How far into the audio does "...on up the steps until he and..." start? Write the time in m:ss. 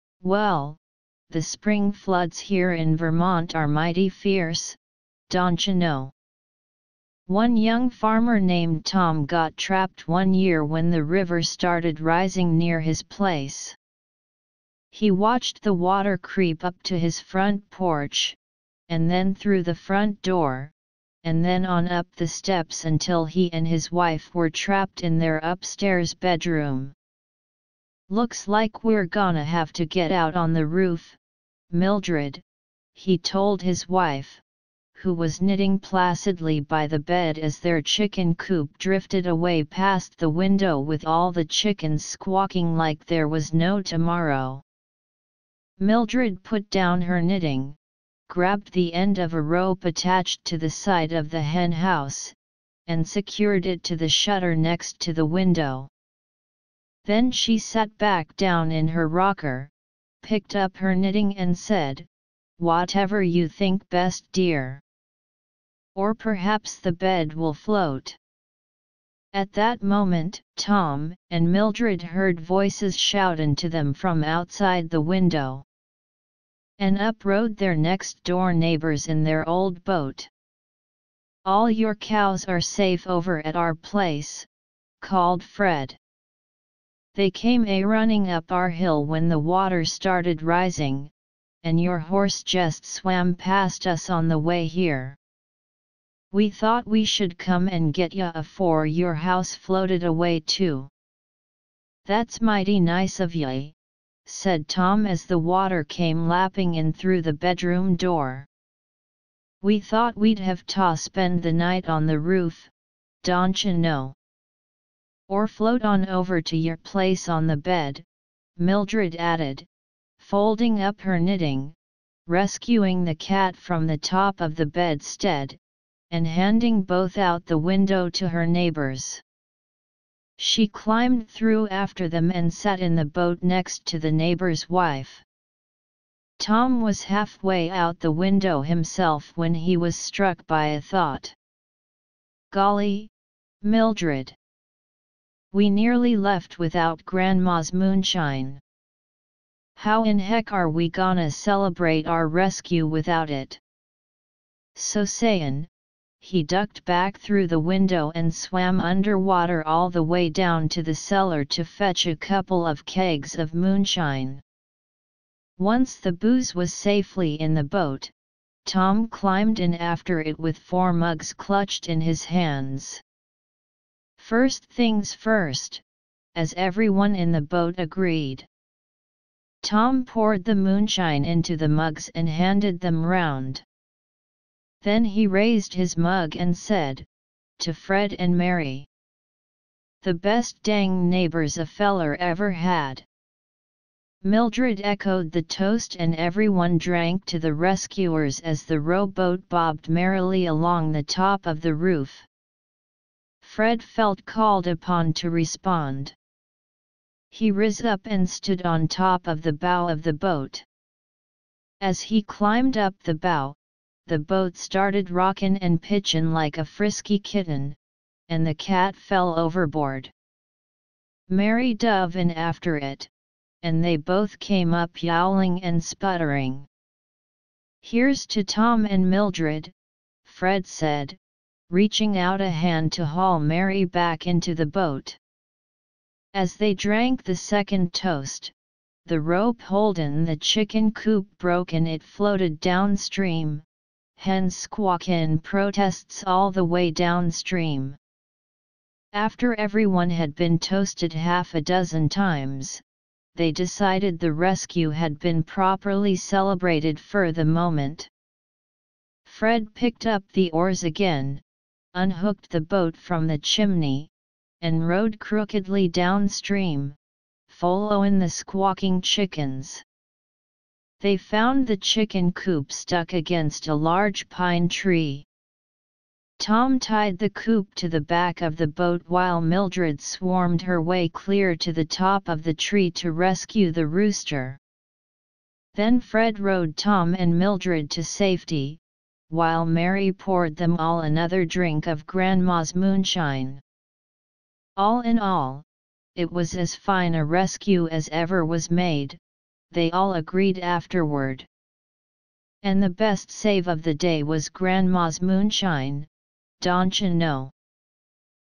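0:21.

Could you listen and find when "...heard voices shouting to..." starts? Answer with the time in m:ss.
1:12.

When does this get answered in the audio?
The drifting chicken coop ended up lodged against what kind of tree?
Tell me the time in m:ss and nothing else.
4:34.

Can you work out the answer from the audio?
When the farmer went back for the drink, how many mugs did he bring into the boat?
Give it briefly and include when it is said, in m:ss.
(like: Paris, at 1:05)
4, at 2:50.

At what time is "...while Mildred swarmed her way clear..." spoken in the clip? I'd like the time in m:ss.
4:39.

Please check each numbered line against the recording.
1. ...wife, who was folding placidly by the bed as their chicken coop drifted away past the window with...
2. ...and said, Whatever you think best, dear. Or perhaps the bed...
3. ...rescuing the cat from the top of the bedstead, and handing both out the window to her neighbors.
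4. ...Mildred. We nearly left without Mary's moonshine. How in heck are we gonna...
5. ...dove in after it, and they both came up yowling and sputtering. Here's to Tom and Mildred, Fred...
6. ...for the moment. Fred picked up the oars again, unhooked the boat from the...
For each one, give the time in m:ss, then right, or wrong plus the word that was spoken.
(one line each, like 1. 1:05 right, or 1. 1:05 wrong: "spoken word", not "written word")
1. 0:33 wrong: "knitting", not "folding"
2. 1:01 right
3. 2:02 right
4. 2:23 wrong: "Grandma", not "Mary"
5. 3:41 right
6. 4:16 right.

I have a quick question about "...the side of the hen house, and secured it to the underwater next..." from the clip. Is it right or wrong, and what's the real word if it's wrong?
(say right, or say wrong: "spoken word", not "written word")
wrong: "shutter", not "underwater".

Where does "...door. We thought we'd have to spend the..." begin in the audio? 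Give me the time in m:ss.
1:47.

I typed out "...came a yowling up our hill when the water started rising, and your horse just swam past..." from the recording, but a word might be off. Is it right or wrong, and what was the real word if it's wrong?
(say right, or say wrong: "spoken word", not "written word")
wrong: "running", not "yowling".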